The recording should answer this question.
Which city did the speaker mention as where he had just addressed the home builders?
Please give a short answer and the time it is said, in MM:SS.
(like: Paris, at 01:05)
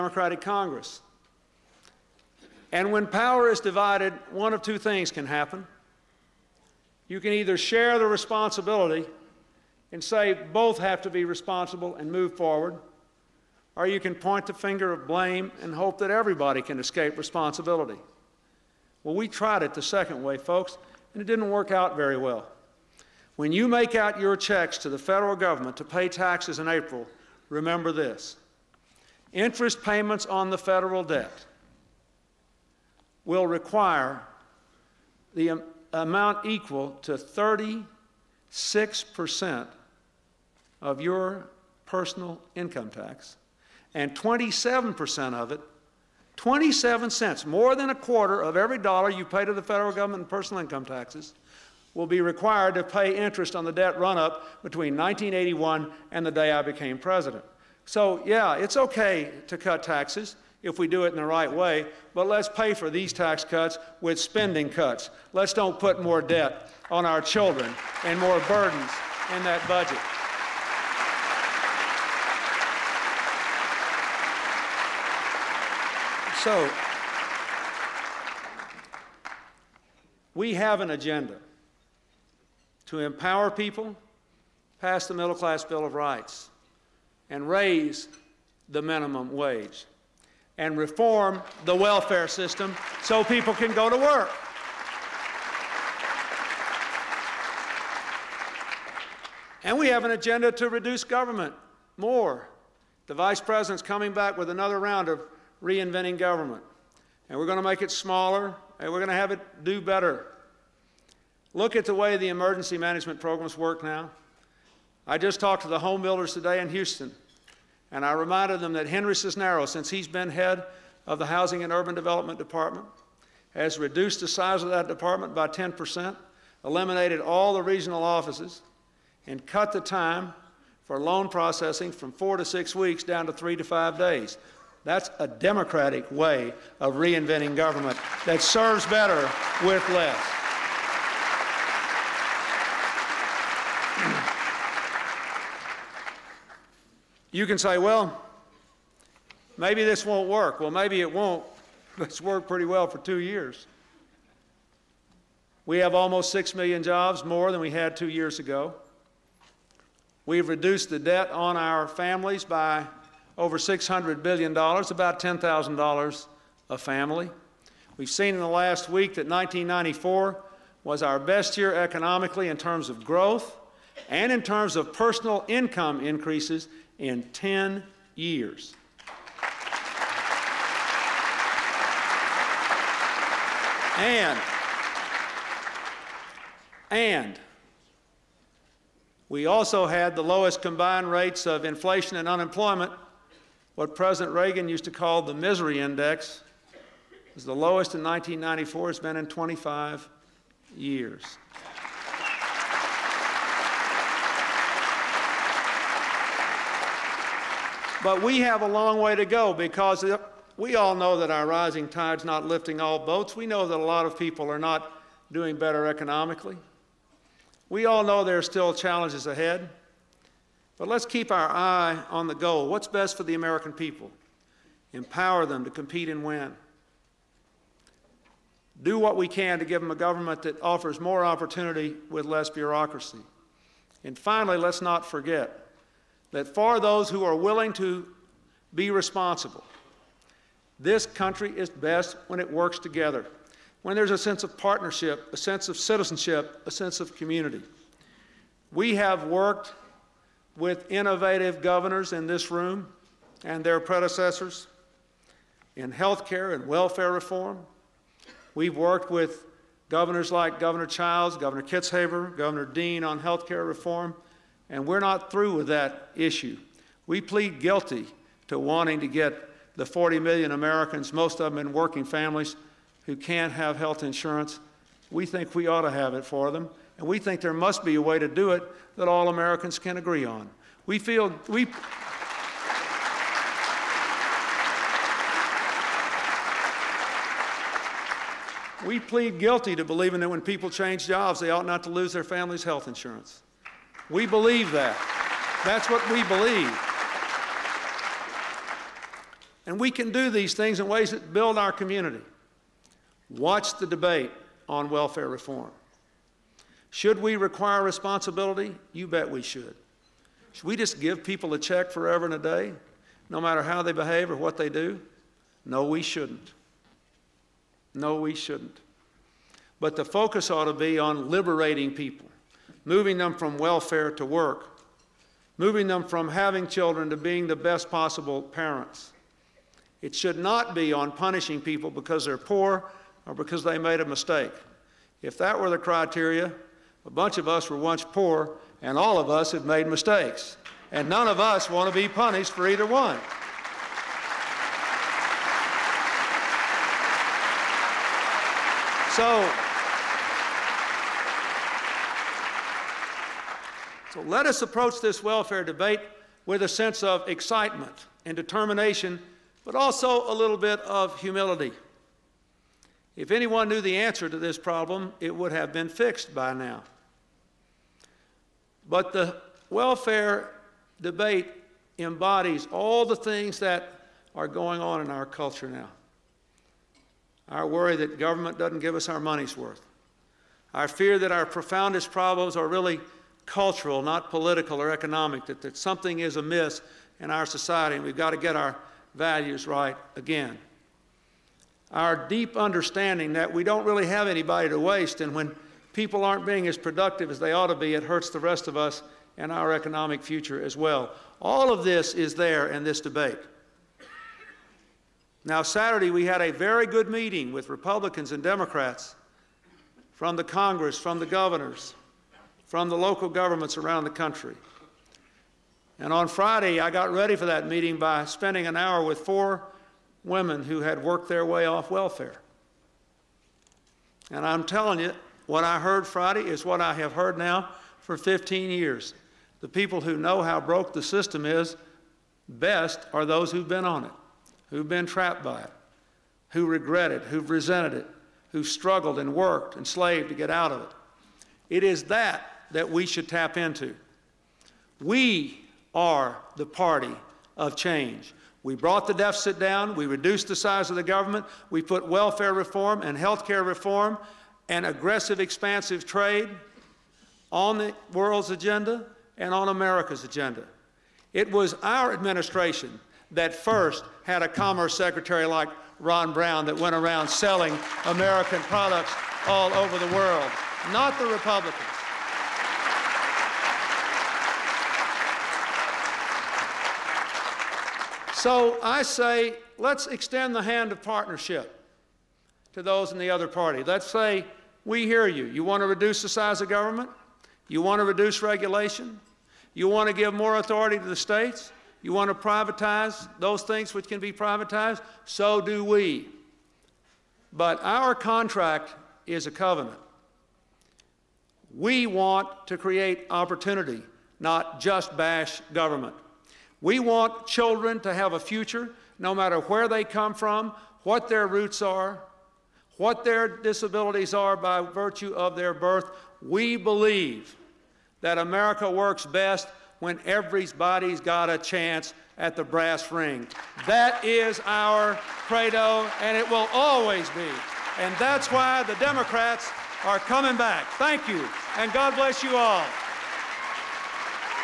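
Houston, at 01:56.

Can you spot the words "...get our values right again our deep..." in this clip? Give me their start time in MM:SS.
06:28.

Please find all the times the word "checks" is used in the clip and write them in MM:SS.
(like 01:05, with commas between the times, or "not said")
00:24, 05:11.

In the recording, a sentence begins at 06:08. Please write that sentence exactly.
But the welfare debate embodies all the things that are going on in our culture now.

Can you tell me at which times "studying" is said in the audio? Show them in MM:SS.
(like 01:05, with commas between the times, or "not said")
not said.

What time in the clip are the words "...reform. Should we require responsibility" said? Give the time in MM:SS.
05:05.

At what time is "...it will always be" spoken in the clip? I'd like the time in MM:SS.
08:46.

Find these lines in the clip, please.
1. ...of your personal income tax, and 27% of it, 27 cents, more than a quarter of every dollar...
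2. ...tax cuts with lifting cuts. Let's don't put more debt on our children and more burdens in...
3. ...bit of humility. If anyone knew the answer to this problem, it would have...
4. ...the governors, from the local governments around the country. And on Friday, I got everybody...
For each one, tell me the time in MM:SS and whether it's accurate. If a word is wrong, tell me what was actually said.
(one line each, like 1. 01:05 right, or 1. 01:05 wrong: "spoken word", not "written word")
1. 00:40 right
2. 01:03 wrong: "spending", not "lifting"
3. 06:00 right
4. 06:51 wrong: "ready", not "everybody".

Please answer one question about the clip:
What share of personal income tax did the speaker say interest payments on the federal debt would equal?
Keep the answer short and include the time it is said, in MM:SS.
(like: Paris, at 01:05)
36%, at 00:37.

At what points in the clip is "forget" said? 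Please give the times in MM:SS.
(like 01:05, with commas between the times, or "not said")
03:55.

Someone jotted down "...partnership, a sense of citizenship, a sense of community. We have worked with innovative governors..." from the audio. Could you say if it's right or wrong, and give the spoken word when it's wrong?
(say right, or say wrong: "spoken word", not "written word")
right.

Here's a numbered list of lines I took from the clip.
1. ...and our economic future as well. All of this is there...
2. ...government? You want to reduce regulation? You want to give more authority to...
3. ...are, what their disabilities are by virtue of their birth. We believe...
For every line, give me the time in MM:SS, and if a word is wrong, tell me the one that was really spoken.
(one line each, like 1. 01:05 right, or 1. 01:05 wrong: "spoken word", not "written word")
1. 06:39 right
2. 08:06 right
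3. 08:31 right.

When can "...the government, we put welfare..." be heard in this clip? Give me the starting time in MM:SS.
07:30.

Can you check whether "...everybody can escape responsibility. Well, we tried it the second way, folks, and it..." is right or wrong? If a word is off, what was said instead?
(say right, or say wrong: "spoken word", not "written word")
right.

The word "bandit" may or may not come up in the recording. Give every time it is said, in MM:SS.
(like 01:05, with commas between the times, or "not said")
not said.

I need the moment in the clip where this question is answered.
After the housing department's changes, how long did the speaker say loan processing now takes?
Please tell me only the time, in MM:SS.
02:13.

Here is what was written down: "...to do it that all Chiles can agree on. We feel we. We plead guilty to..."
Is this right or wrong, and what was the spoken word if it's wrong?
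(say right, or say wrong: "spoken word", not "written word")
wrong: "Americans", not "Chiles".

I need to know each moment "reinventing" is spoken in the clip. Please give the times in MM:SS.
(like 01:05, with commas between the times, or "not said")
01:45, 02:16.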